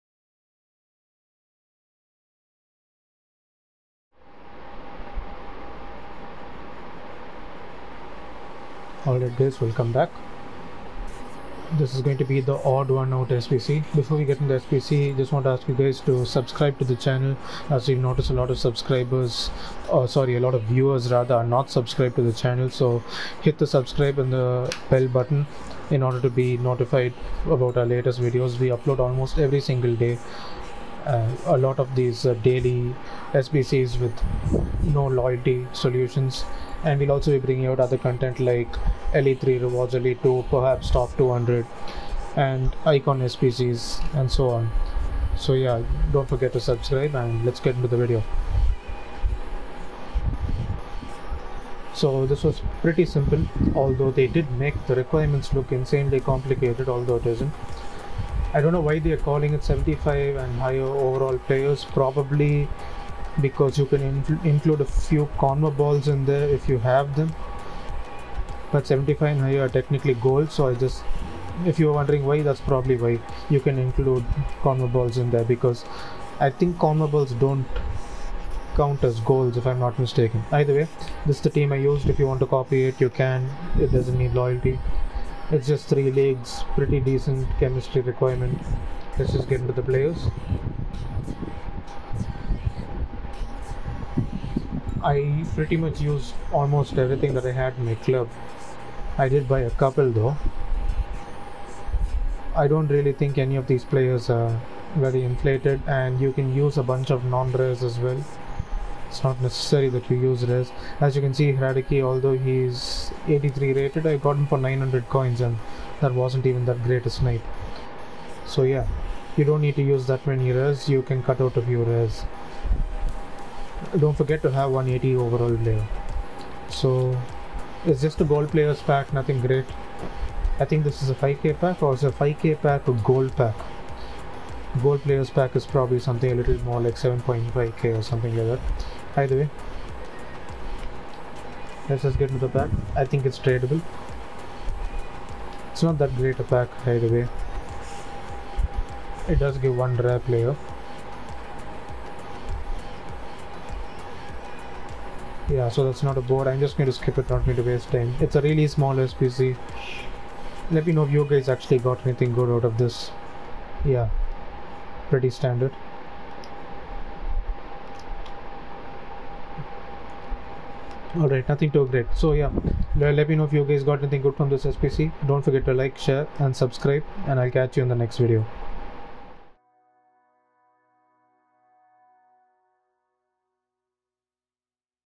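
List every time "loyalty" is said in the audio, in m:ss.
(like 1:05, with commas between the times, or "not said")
0:35, 1:24.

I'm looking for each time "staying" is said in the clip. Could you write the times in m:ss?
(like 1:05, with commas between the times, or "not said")
not said.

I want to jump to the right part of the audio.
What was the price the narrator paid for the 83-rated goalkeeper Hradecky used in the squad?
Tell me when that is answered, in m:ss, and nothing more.
1:54.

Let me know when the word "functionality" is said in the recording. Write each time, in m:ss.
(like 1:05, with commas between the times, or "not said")
not said.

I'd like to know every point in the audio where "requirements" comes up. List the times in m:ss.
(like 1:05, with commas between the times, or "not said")
0:54, 1:27.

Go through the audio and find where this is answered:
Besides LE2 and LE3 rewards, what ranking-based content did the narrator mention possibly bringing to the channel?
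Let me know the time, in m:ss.
0:40.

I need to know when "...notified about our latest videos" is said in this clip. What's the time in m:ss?
0:26.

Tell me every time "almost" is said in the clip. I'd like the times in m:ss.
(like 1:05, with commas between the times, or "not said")
0:28, 1:36.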